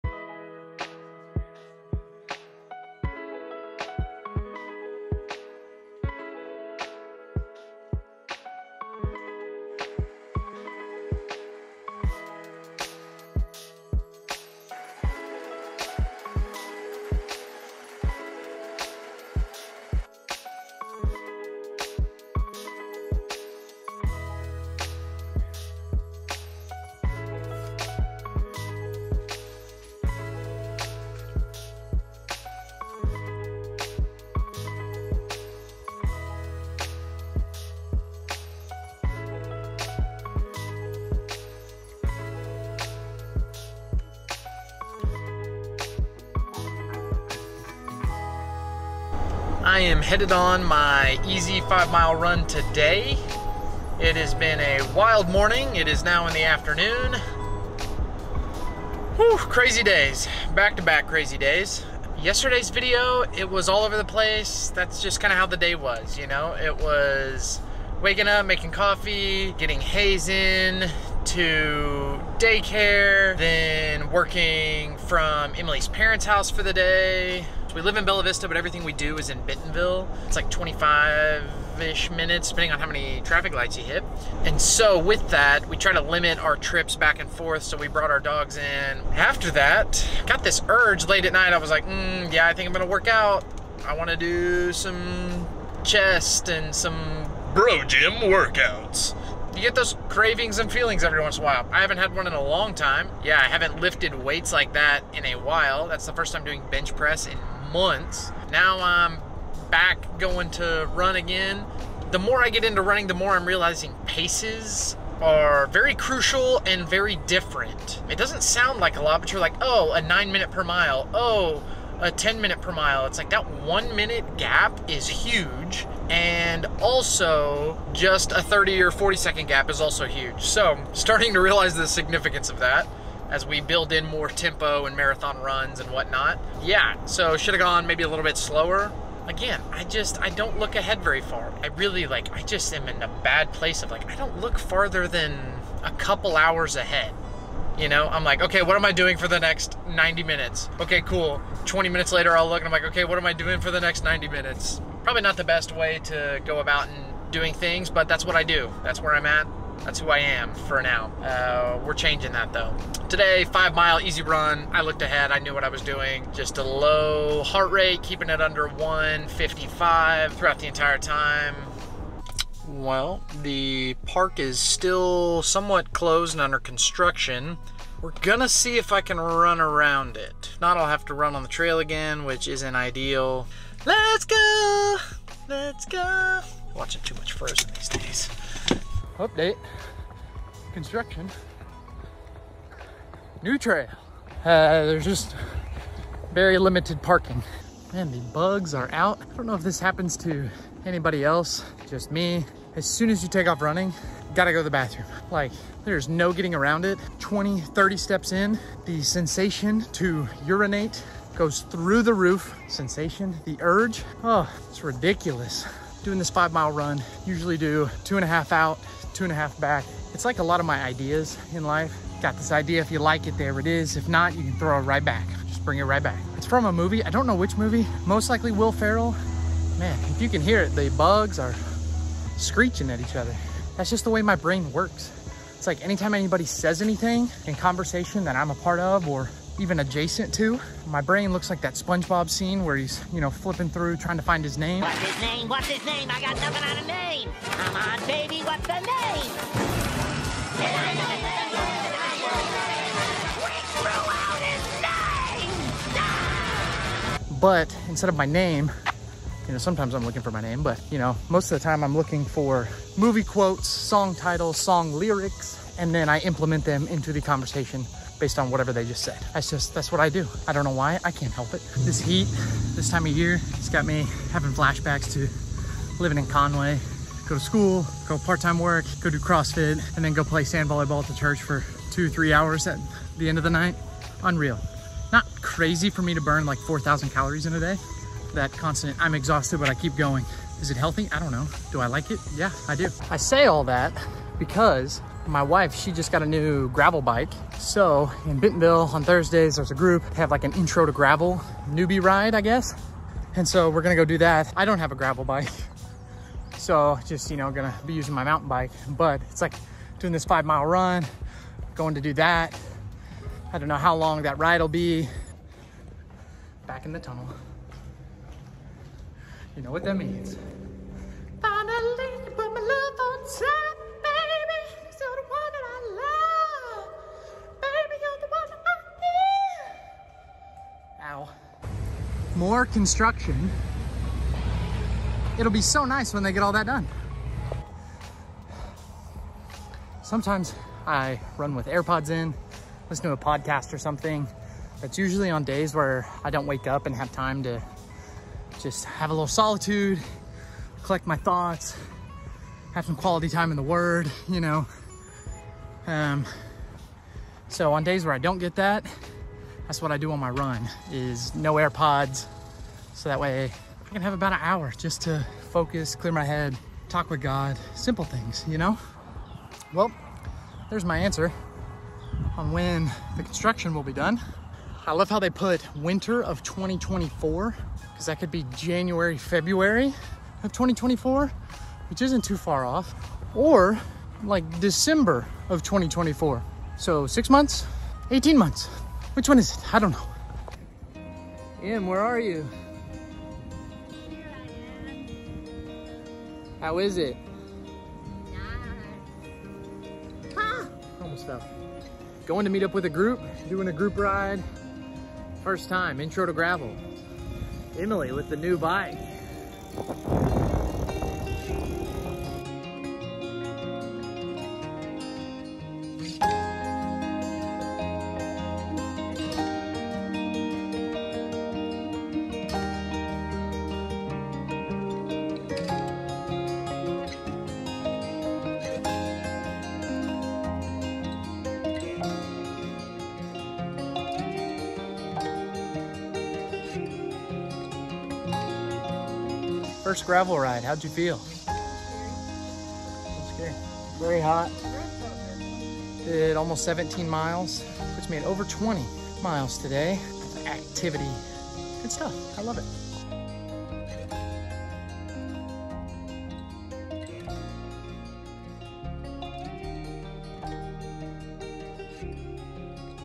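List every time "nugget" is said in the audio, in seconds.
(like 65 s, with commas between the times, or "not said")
not said.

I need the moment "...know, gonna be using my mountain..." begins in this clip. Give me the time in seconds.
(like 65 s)
307 s.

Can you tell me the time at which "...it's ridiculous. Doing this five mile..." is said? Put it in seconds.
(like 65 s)
214 s.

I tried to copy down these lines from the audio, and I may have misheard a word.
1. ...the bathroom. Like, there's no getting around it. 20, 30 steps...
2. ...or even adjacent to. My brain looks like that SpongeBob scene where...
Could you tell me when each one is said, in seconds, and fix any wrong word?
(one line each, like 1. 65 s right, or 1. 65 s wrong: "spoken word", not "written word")
1. 204 s right
2. 239 s right.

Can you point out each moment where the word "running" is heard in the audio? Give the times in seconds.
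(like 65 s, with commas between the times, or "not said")
112 s, 203 s.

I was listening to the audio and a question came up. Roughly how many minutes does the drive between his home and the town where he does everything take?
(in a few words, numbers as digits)
25.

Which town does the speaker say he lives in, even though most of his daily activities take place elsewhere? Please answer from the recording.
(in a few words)
Bella Vista.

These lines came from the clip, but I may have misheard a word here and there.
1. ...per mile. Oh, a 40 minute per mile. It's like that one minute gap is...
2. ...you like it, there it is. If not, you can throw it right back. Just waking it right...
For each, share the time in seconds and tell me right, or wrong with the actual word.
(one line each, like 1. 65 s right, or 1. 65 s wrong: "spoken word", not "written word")
1. 120 s wrong: "10", not "40"
2. 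222 s wrong: "bring", not "waking".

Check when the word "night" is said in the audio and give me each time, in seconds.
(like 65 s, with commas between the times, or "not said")
91 s, 283 s.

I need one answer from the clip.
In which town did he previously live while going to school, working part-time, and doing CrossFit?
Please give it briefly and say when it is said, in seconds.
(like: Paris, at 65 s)
Conway, at 276 s.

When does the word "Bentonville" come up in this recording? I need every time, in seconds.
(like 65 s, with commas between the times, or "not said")
79 s, 298 s.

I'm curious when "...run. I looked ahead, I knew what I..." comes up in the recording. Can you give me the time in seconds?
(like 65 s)
164 s.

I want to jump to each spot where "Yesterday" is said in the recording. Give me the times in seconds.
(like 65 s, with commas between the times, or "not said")
62 s.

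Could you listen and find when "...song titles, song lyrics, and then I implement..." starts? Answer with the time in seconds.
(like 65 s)
263 s.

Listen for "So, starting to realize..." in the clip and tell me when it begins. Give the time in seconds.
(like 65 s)
130 s.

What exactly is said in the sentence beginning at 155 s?
Probably not the best way to go about and doing things, but that's what I do.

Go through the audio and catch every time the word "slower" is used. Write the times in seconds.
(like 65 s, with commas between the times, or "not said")
138 s.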